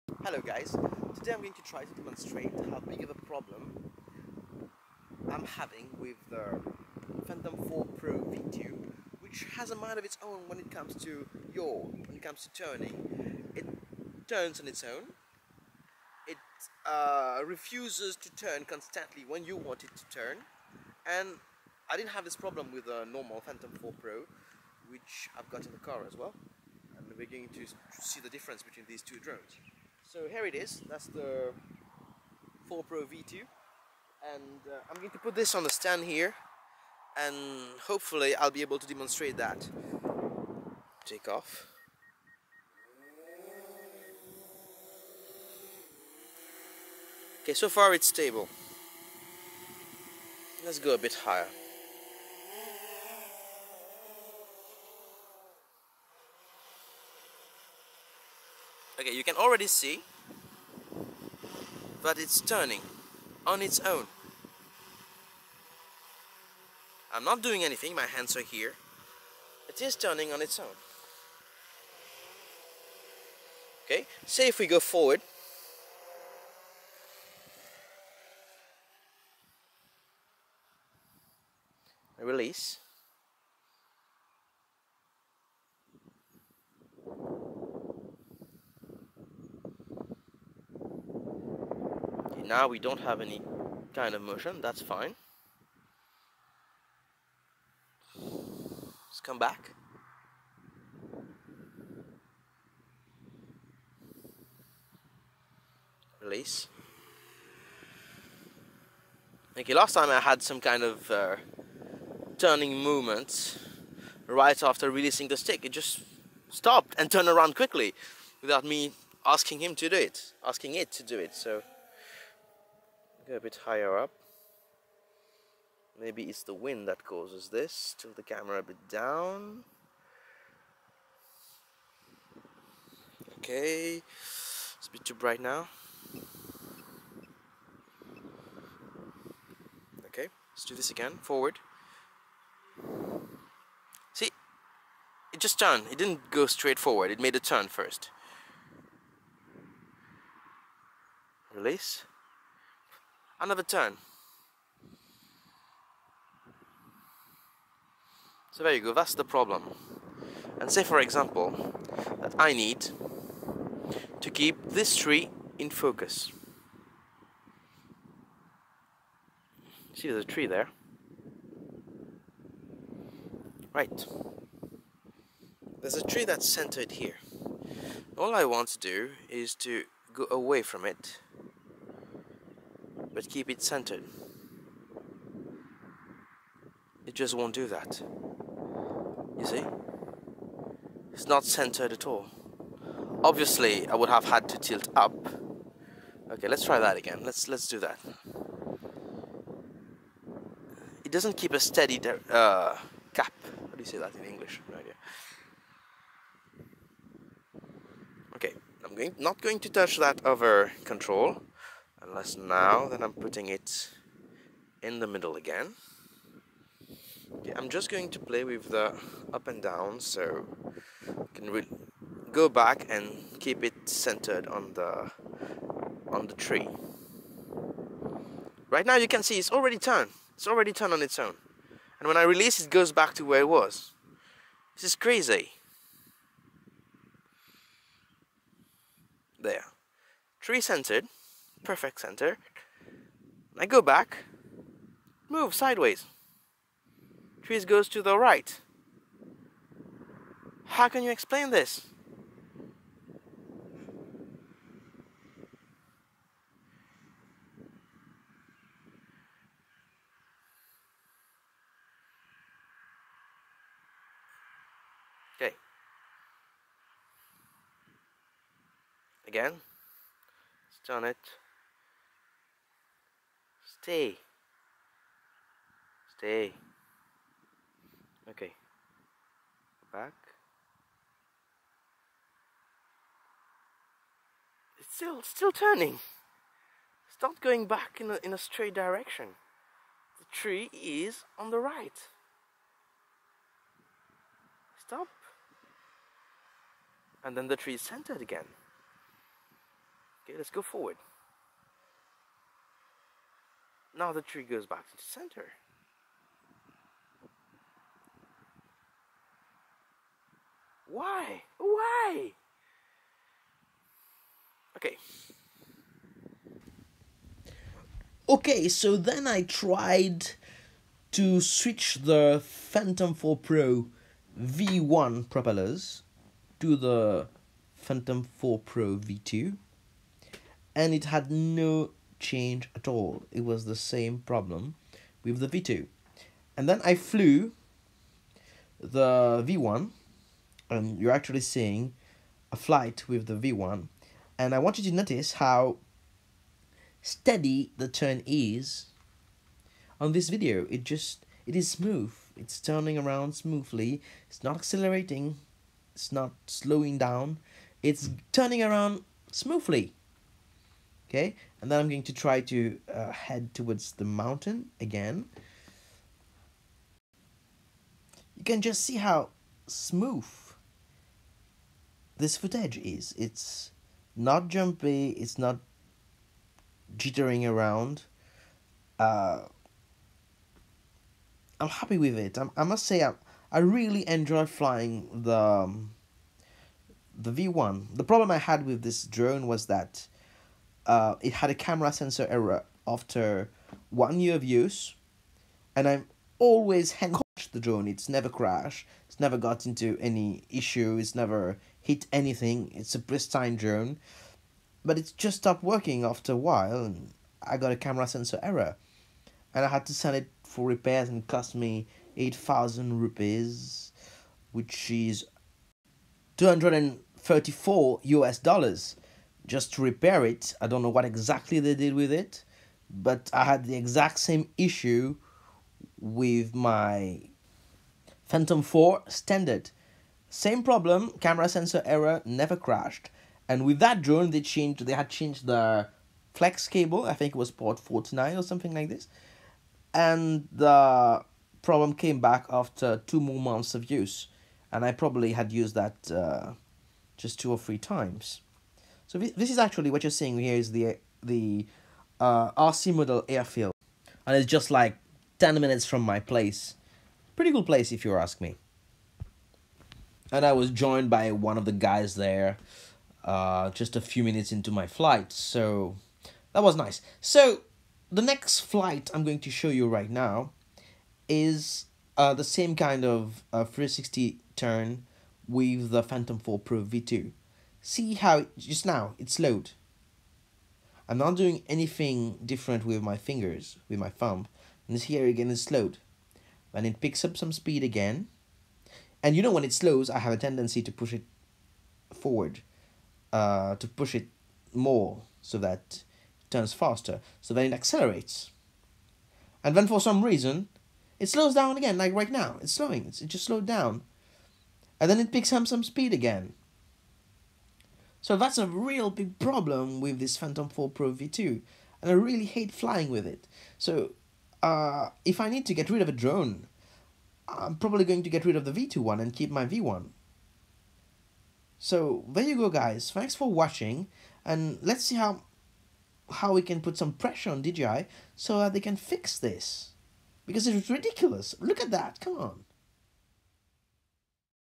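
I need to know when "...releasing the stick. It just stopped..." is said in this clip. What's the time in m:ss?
1:54.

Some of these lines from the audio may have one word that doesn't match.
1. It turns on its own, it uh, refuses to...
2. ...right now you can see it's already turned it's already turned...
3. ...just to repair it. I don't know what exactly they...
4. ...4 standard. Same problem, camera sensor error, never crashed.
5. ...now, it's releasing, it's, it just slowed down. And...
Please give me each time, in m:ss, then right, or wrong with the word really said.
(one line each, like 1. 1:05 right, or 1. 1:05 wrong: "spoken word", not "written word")
1. 0:13 right
2. 3:48 right
3. 6:59 right
4. 7:08 right
5. 8:22 wrong: "slowing", not "releasing".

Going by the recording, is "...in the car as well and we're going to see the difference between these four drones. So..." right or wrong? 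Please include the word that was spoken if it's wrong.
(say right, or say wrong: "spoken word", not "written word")
wrong: "two", not "four".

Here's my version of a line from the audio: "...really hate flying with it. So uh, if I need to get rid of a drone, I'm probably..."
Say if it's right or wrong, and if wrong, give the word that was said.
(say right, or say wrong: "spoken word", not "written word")
right.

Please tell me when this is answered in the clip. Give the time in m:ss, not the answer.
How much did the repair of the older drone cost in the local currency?
6:52.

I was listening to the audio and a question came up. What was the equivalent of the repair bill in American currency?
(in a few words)
$234.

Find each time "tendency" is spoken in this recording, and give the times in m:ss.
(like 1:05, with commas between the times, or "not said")
8:10.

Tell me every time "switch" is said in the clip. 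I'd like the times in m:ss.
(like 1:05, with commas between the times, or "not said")
5:21.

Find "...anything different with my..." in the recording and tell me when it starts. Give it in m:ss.
8:01.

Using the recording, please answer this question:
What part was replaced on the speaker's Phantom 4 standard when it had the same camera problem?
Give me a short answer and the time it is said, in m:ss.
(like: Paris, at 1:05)
The flex cable, at 7:16.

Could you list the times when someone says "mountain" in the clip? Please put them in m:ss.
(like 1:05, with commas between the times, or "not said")
6:04.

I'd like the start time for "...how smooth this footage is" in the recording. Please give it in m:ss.
6:08.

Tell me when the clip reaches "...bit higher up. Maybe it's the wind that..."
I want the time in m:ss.
2:03.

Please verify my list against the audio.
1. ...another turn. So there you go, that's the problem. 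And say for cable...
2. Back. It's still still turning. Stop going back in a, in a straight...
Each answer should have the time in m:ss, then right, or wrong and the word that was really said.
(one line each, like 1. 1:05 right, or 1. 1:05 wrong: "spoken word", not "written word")
1. 2:33 wrong: "example", not "cable"
2. 4:39 right.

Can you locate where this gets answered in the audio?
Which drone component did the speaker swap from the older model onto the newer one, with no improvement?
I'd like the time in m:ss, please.
5:25.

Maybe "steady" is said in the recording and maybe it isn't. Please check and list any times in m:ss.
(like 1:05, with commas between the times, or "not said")
3:21, 5:47.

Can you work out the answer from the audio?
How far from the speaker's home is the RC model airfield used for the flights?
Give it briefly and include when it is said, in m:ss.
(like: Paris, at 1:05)
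10 minutes, at 7:35.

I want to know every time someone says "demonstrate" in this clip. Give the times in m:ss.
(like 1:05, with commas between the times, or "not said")
0:01, 0:38.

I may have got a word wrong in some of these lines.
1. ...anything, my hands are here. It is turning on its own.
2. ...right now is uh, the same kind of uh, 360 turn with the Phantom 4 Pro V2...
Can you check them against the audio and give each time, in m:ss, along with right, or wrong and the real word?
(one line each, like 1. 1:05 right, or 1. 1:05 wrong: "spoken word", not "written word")
1. 1:07 right
2. 7:49 right.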